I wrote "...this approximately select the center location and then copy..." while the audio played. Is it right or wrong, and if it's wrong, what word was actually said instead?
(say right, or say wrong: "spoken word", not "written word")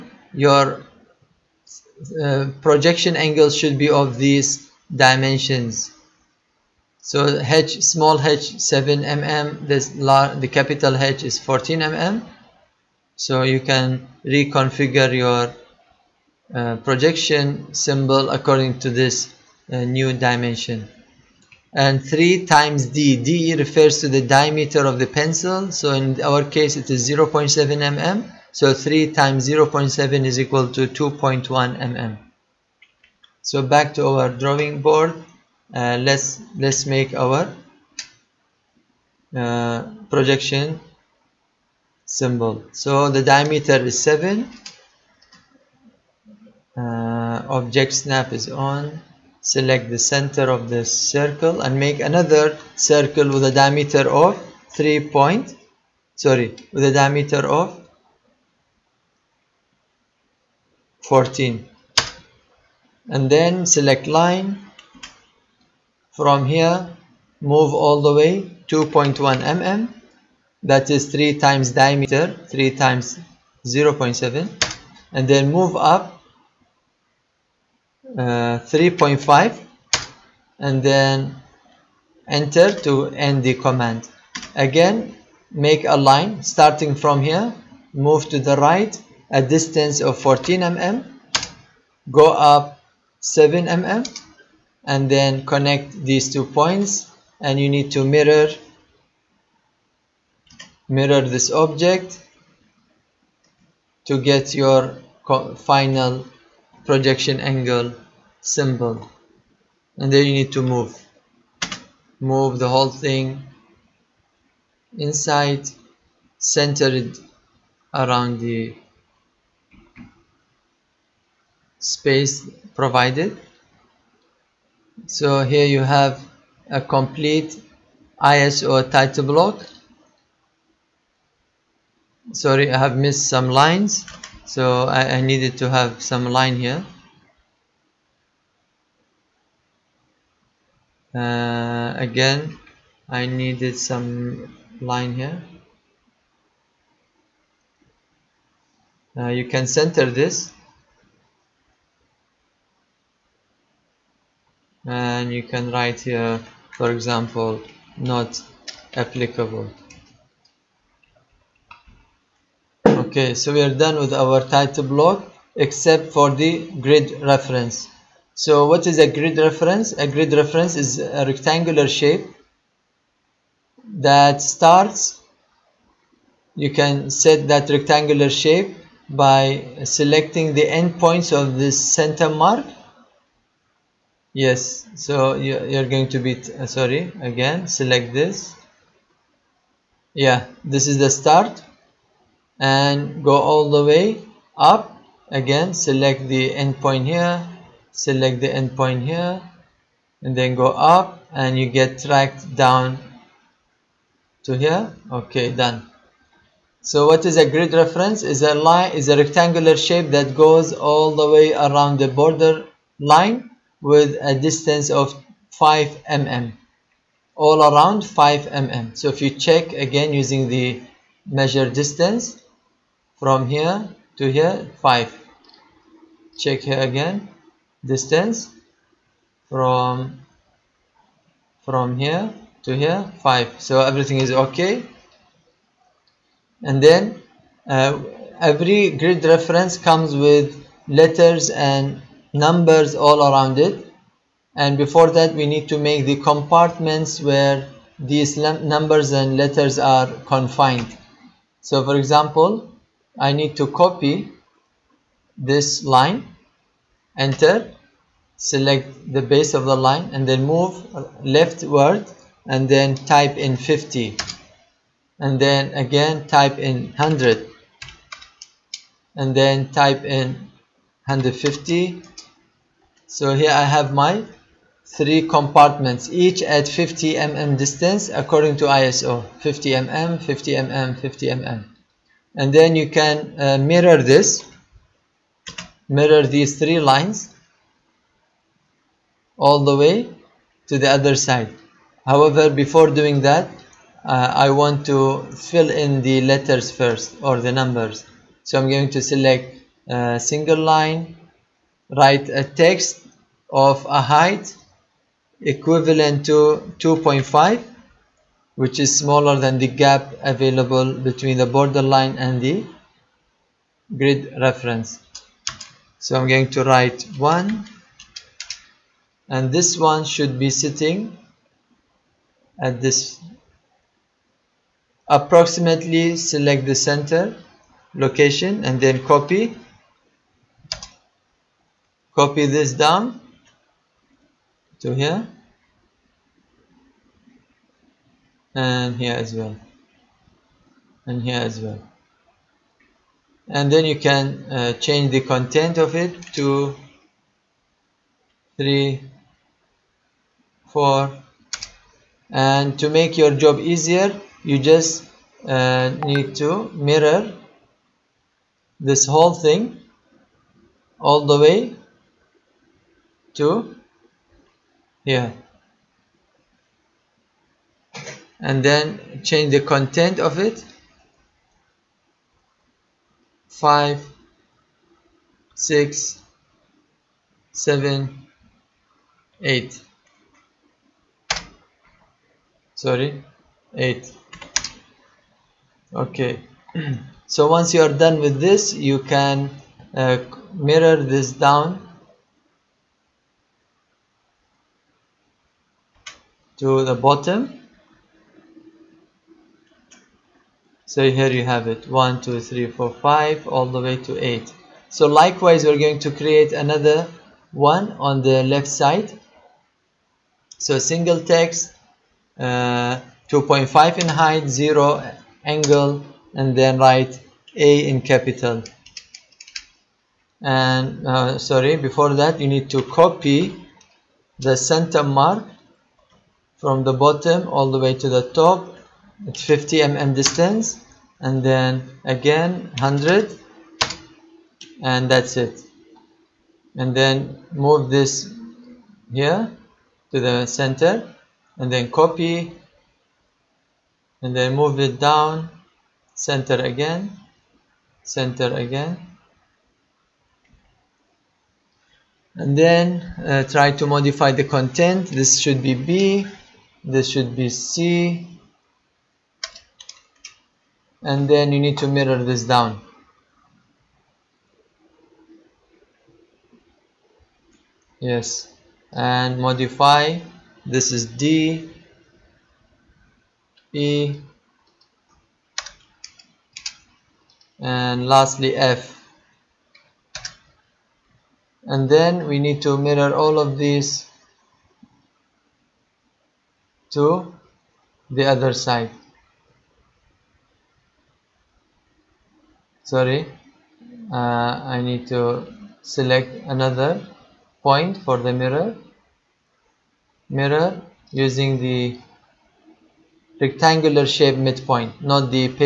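right.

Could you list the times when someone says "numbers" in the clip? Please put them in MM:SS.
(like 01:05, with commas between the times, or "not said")
04:02, 04:08, 04:57.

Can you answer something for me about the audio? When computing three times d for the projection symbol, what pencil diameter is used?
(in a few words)
0.7 mm.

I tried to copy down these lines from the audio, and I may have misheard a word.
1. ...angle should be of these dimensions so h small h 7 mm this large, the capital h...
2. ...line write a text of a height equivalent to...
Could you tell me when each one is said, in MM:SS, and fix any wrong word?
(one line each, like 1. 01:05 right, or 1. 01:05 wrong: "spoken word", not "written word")
1. 00:03 right
2. 05:00 right.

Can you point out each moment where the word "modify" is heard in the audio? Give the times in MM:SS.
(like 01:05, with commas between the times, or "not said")
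07:33, 07:49.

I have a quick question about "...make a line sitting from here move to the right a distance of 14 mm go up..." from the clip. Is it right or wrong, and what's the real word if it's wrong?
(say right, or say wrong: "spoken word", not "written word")
wrong: "starting", not "sitting".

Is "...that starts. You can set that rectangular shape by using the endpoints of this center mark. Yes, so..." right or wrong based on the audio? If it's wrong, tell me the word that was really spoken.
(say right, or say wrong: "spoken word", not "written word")
wrong: "selecting", not "using".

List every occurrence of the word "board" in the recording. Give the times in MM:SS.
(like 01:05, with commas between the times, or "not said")
00:34.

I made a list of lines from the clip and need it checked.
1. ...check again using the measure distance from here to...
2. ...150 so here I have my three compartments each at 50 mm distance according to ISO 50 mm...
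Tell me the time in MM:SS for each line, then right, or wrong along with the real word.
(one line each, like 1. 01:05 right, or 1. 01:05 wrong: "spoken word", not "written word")
1. 03:39 right
2. 04:31 right.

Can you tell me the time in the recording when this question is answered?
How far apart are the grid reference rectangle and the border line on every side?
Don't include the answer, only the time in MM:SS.
03:35.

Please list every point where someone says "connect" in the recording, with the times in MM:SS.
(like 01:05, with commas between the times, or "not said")
01:35.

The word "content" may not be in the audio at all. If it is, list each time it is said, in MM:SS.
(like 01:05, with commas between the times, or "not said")
05:45, 06:09, 07:34.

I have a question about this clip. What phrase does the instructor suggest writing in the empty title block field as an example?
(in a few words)
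not applicable.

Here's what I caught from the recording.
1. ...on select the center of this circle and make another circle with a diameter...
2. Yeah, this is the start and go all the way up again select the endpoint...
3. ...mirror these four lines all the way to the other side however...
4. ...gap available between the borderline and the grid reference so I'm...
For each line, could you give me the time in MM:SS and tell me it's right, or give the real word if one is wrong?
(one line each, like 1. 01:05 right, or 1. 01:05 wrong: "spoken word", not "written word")
1. 00:48 right
2. 03:10 right
3. 04:45 wrong: "three", not "four"
4. 05:09 right.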